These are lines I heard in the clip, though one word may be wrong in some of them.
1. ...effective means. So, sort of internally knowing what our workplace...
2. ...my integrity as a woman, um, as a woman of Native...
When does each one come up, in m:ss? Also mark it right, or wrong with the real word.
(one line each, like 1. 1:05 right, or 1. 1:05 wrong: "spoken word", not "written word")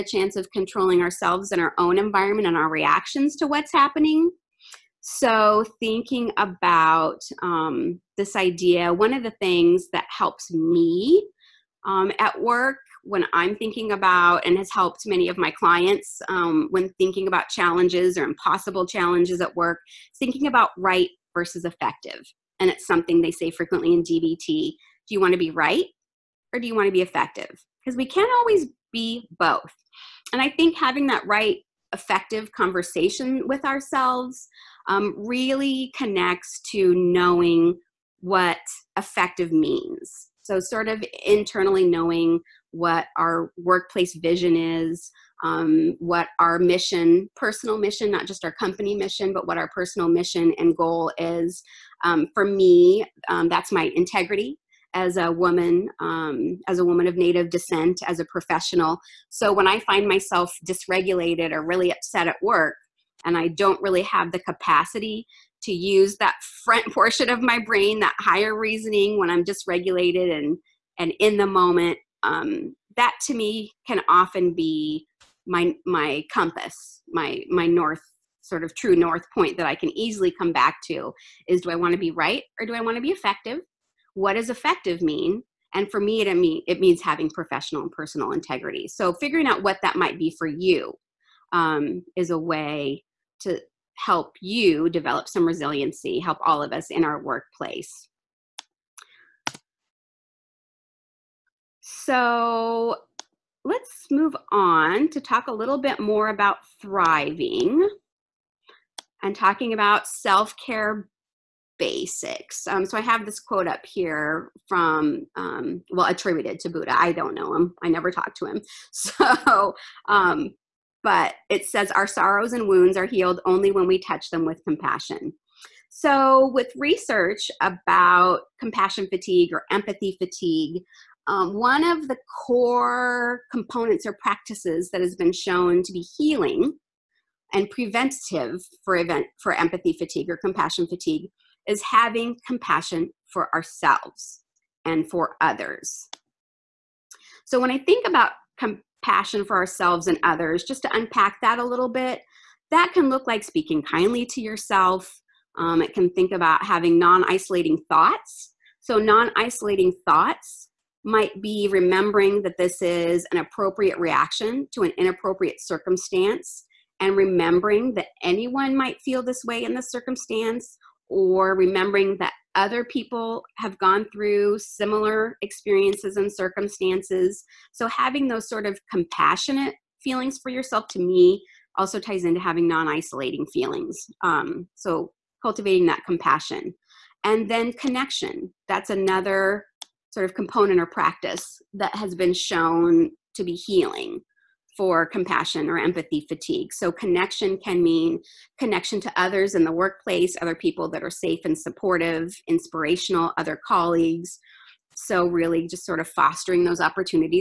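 1. 0:38 right
2. 0:53 right.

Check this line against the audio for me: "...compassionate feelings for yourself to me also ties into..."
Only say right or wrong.
right.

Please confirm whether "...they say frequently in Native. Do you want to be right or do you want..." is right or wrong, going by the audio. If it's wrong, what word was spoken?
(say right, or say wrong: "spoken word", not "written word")
wrong: "DBT", not "Native".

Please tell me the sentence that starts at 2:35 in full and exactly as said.
Um, it can think about having non isolating thoughts.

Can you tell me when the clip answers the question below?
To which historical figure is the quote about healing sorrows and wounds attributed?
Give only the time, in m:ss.
1:56.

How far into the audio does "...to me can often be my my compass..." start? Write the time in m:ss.
1:13.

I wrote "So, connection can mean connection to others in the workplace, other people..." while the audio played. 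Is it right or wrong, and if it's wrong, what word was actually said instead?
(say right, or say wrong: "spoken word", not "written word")
right.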